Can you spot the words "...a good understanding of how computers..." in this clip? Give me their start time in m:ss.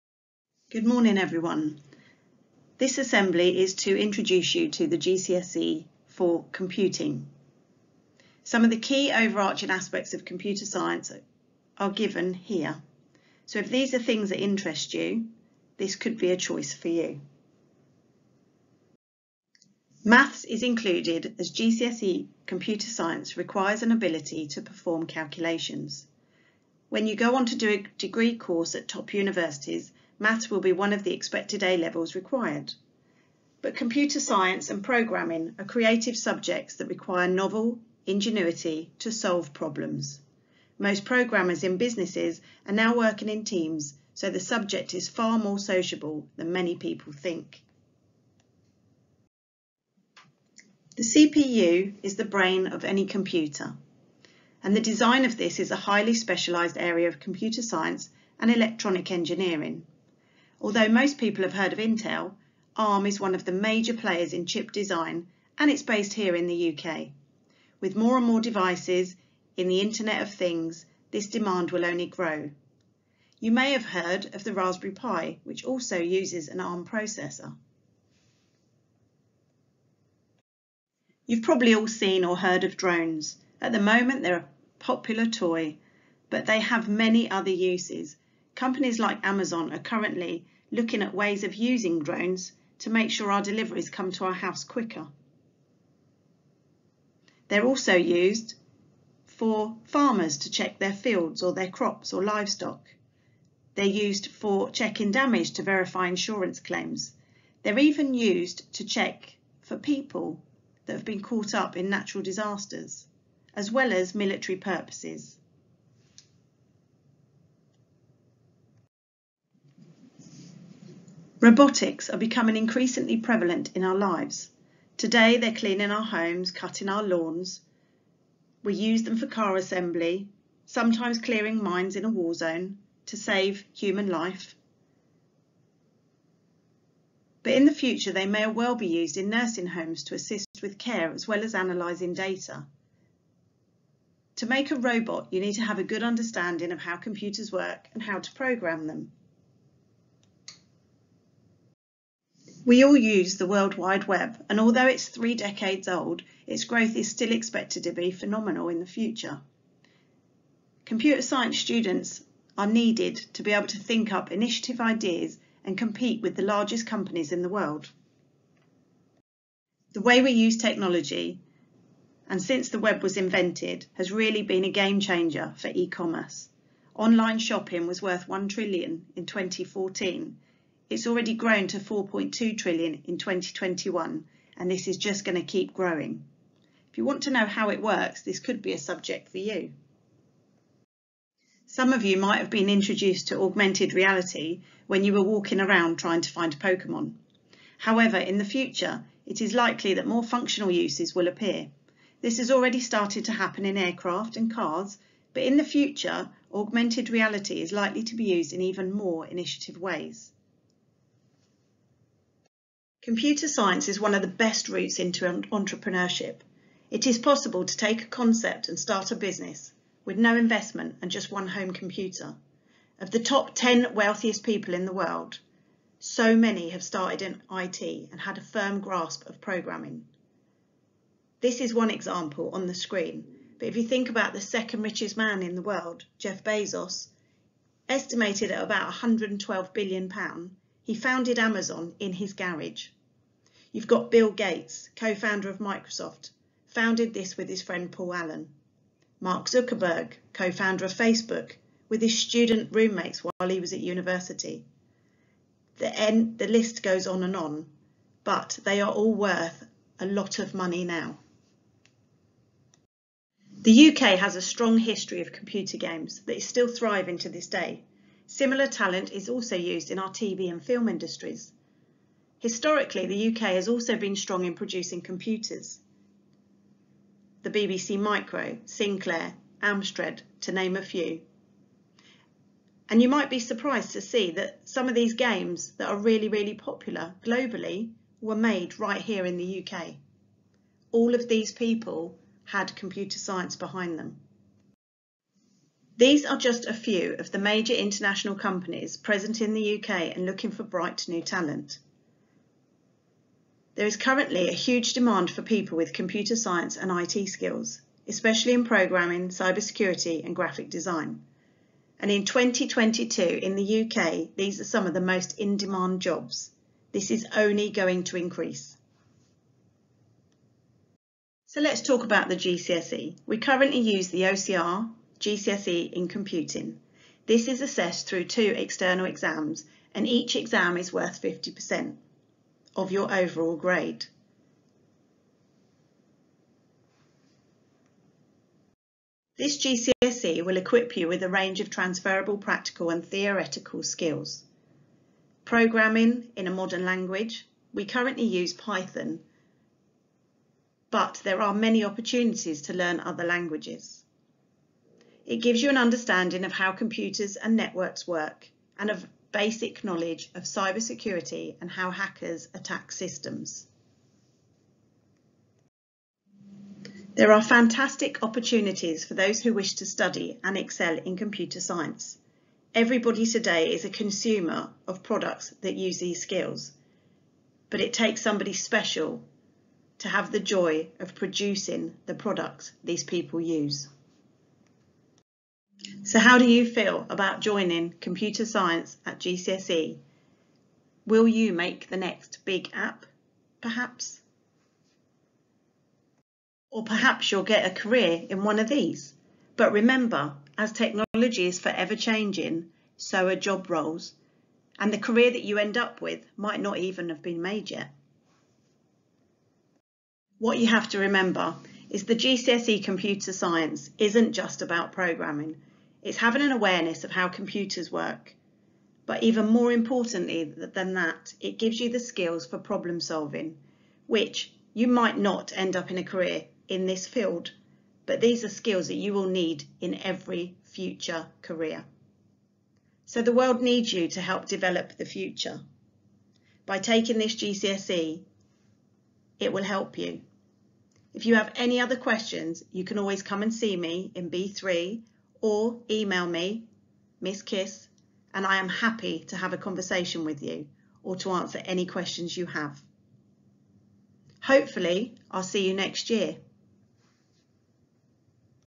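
2:25.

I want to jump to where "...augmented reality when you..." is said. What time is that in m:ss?
3:13.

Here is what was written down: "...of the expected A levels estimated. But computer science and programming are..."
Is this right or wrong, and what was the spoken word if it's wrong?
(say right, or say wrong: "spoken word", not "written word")
wrong: "required", not "estimated".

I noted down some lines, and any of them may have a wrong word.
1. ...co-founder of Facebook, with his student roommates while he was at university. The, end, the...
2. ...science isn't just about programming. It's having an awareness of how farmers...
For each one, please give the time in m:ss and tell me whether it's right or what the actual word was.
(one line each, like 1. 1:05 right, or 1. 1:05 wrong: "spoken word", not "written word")
1. 4:10 right
2. 6:53 wrong: "computers", not "farmers".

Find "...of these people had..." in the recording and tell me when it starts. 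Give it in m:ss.
4:51.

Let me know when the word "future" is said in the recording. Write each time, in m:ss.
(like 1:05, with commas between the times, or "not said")
2:17, 2:38, 3:18, 3:25, 7:10, 7:15.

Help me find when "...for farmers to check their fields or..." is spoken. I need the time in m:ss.
1:39.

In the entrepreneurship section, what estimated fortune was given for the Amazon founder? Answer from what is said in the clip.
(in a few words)
112 billion pounds.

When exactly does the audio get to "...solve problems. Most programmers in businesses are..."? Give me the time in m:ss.
0:39.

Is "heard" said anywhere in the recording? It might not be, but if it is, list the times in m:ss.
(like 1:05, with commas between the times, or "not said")
1:01, 1:13, 1:22.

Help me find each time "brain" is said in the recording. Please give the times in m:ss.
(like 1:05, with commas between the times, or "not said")
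0:52.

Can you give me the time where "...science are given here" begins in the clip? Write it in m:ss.
0:10.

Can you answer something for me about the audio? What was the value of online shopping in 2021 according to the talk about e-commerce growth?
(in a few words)
4.2 trillion.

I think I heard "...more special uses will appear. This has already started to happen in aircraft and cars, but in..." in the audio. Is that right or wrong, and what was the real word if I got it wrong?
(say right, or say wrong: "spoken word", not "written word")
wrong: "functional", not "special".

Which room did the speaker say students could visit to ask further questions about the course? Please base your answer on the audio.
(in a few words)
B3.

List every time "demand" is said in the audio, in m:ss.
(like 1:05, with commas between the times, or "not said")
1:11, 5:04, 5:15.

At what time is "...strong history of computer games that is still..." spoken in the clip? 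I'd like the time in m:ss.
4:24.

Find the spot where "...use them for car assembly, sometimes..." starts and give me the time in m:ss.
2:08.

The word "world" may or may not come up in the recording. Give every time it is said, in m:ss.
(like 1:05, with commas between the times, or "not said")
2:33, 2:47, 3:44, 3:55, 7:13.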